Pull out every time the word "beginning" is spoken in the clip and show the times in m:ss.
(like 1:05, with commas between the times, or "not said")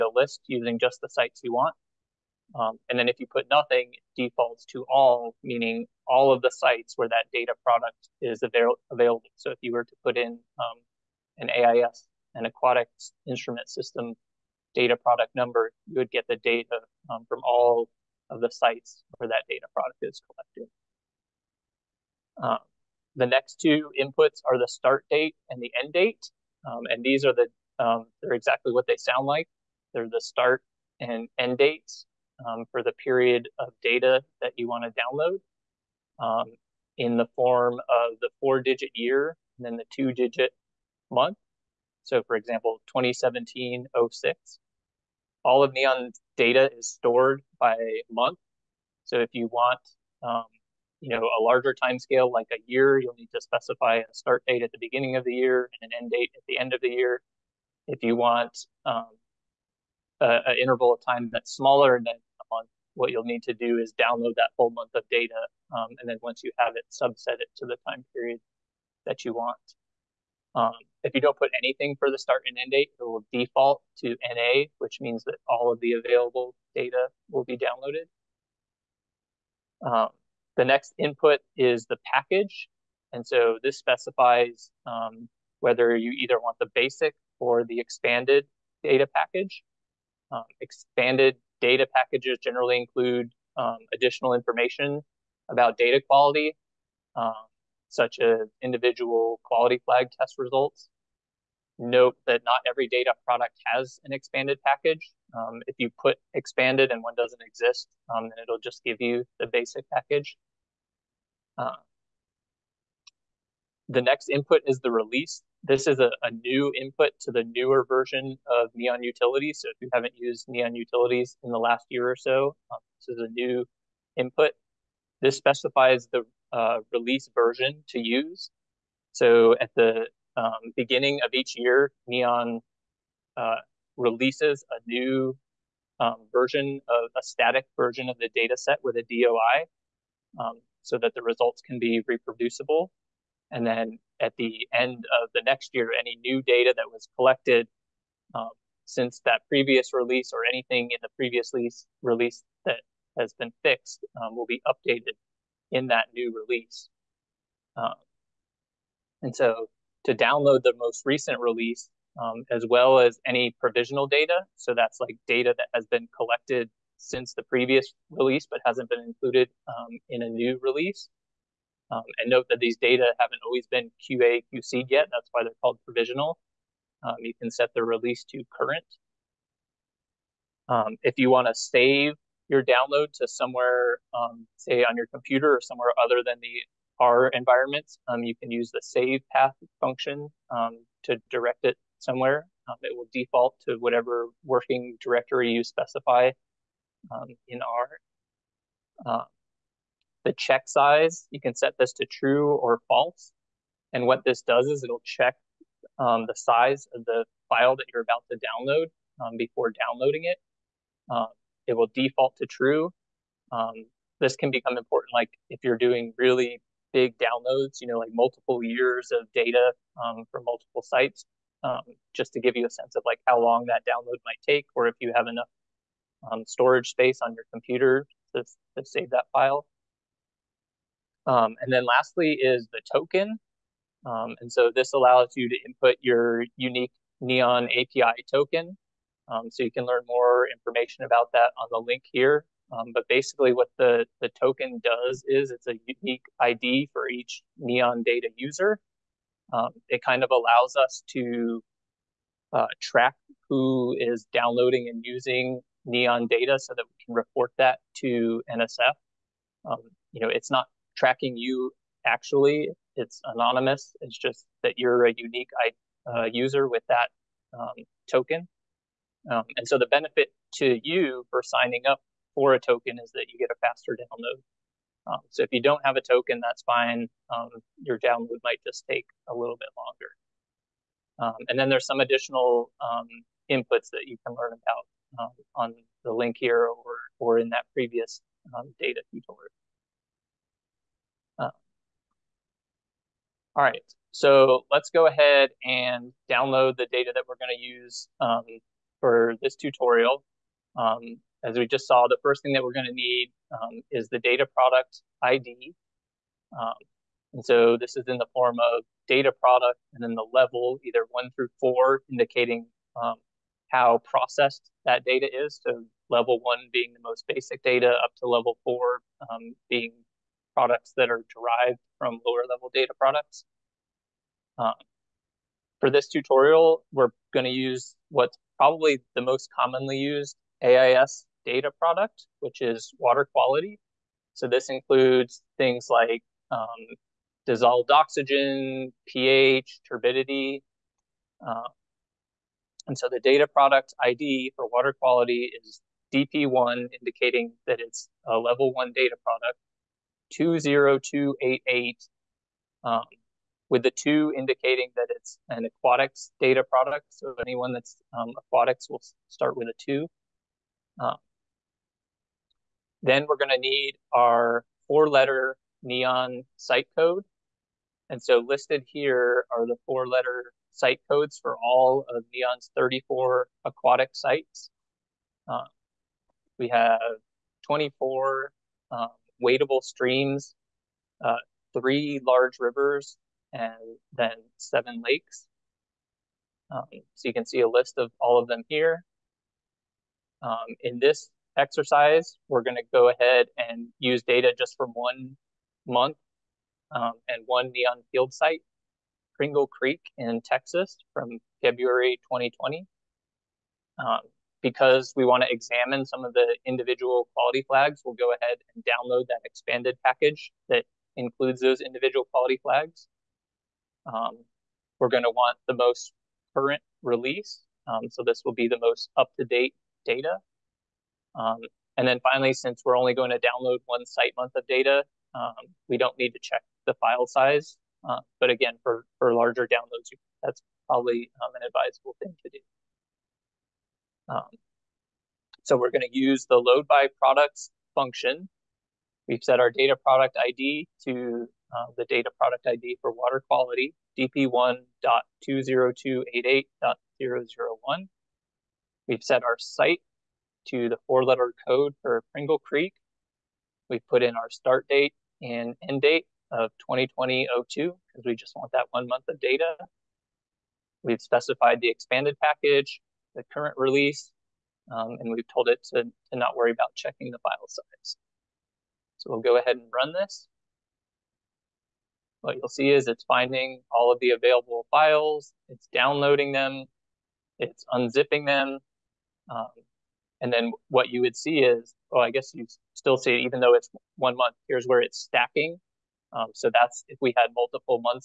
0:54, 2:10.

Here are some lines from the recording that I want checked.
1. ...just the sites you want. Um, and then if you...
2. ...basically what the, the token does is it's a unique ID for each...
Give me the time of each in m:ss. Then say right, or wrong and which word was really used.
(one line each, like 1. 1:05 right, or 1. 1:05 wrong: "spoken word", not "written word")
1. 0:00 right
2. 4:03 right.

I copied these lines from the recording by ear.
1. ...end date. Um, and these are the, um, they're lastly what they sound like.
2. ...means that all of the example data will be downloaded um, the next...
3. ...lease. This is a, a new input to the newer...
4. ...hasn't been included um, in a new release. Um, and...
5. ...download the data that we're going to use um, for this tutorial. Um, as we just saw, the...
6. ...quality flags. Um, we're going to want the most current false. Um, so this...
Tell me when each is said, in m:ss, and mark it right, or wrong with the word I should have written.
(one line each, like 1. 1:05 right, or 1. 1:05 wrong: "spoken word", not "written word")
1. 0:25 wrong: "exactly", not "lastly"
2. 1:14 wrong: "available", not "example"
3. 1:54 wrong: "release", not "lease"
4. 2:48 right
5. 4:56 right
6. 6:52 wrong: "release", not "false".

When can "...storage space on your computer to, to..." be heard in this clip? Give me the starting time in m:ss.
3:46.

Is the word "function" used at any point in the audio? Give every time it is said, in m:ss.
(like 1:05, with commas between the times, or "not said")
3:09, 7:17.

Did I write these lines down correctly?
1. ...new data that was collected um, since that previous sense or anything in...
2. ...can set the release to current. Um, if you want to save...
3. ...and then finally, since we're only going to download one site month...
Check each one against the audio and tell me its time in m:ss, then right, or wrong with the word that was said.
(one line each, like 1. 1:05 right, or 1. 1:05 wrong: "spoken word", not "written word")
1. 2:26 wrong: "release", not "sense"
2. 2:57 right
3. 7:01 right.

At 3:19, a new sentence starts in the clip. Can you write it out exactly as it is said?
Um, the check size, you can set this to true or false.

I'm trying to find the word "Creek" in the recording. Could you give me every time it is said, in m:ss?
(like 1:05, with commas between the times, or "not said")
6:39, 7:32.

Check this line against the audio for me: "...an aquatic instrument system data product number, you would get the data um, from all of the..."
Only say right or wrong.
right.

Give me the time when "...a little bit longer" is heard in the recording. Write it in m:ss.
4:39.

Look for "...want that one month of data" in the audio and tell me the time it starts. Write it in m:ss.
7:38.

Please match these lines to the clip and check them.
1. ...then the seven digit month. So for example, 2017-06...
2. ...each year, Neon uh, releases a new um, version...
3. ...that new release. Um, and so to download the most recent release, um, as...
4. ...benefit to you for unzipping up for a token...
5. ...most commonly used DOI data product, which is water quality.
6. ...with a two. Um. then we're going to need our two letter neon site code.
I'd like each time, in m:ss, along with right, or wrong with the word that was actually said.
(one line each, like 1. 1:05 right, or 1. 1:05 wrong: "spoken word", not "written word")
1. 0:39 wrong: "two", not "seven"
2. 2:11 right
3. 2:35 right
4. 4:29 wrong: "signing", not "unzipping"
5. 5:29 wrong: "AIS", not "DOI"
6. 5:59 wrong: "four", not "two".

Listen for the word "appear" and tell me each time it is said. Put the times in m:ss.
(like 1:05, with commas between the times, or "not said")
not said.